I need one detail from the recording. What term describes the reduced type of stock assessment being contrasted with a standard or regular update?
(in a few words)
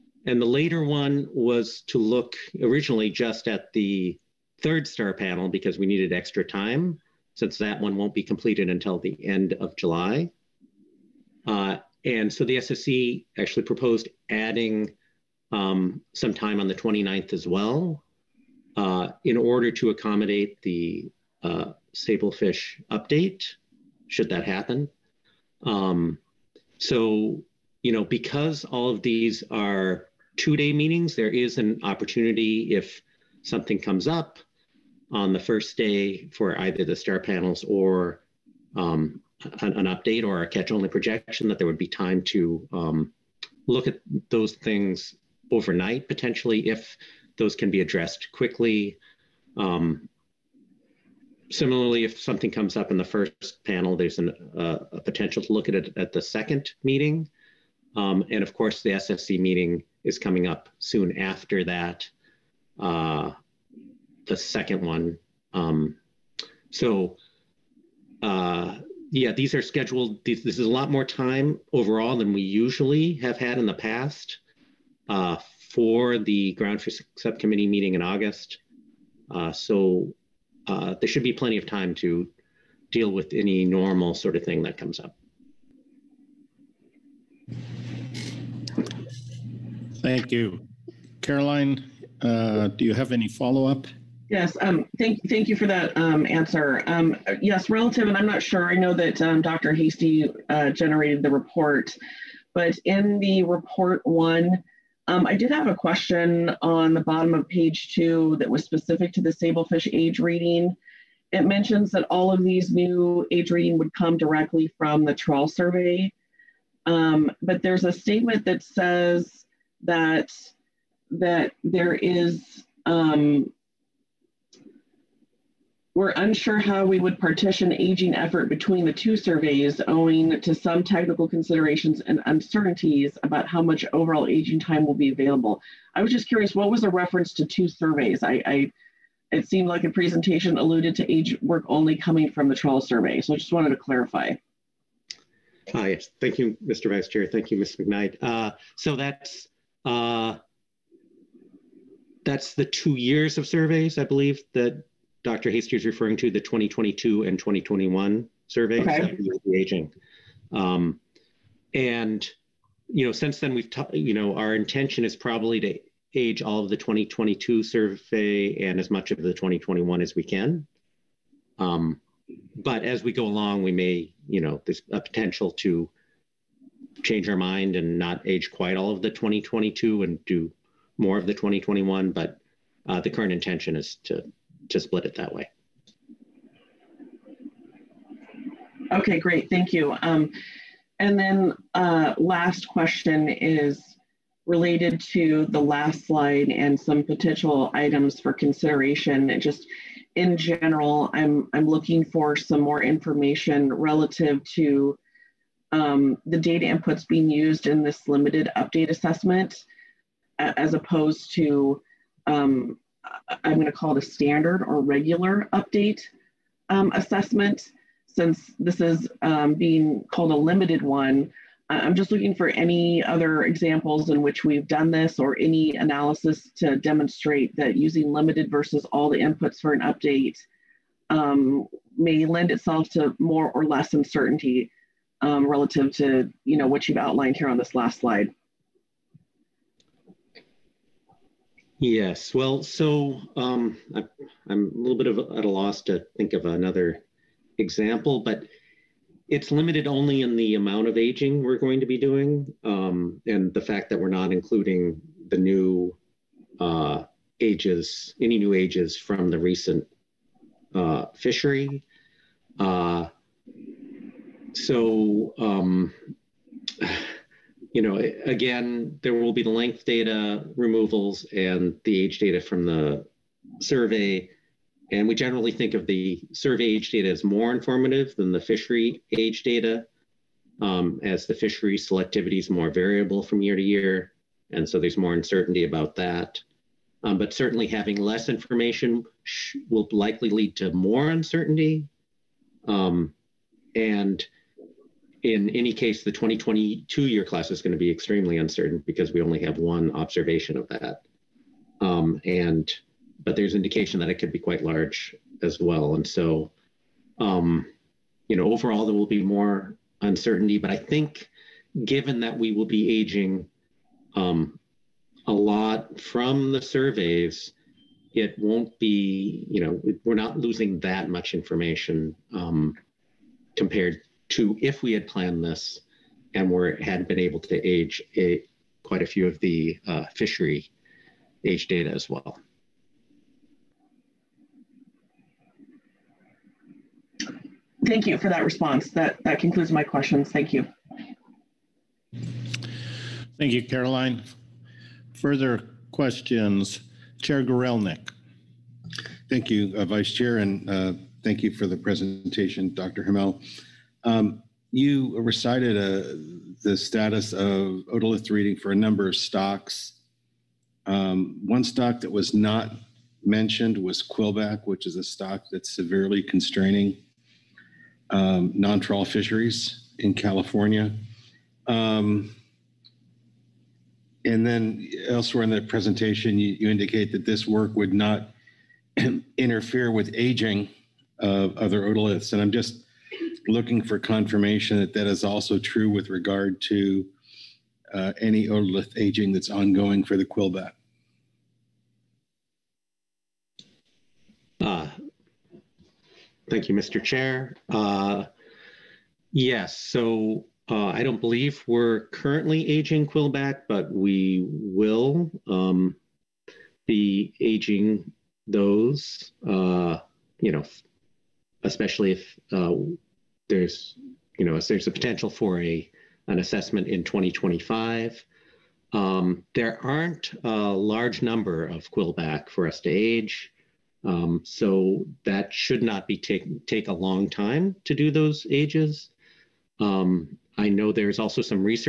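Limited update assessment.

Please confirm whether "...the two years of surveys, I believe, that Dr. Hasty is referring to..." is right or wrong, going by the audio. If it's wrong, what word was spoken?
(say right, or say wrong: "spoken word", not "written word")
right.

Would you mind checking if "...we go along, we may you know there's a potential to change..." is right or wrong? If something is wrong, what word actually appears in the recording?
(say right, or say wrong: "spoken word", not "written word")
right.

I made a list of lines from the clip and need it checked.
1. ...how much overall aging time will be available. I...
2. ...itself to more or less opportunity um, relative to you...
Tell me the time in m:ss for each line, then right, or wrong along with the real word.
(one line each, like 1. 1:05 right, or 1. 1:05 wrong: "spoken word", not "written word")
1. 2:13 right
2. 3:52 wrong: "uncertainty", not "opportunity".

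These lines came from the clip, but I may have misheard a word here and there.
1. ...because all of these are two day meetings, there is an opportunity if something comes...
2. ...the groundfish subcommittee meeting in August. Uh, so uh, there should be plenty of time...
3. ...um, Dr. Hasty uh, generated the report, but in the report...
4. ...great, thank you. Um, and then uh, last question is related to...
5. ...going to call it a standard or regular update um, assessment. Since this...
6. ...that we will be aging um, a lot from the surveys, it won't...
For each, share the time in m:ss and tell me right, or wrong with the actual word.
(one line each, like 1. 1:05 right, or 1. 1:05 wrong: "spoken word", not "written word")
1. 0:28 right
2. 1:16 right
3. 1:39 right
4. 3:09 right
5. 3:33 right
6. 5:12 right.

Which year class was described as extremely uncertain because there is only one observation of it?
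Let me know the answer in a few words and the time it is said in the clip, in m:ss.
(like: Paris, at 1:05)
2022, at 4:56.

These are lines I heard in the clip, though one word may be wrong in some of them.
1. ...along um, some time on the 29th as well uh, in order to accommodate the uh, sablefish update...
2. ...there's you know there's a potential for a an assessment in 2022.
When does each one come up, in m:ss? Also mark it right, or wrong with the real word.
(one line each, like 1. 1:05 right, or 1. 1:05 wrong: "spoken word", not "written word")
1. 0:14 wrong: "adding", not "along"
2. 6:53 wrong: "2025", not "2022".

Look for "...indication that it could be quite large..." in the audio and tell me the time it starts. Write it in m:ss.
5:03.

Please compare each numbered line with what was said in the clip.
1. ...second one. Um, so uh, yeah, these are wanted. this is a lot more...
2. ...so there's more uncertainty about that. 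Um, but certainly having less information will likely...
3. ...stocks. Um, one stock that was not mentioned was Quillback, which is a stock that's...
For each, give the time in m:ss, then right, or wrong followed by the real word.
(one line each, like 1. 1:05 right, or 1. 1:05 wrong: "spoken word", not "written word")
1. 1:04 wrong: "scheduled", not "wanted"
2. 4:44 right
3. 5:59 right.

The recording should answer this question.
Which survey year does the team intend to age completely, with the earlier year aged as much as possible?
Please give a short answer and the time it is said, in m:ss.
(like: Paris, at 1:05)
2022, at 2:46.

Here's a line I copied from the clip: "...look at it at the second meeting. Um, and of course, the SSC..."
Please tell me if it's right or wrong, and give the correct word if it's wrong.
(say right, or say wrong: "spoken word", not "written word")
right.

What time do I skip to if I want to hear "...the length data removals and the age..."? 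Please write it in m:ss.
4:29.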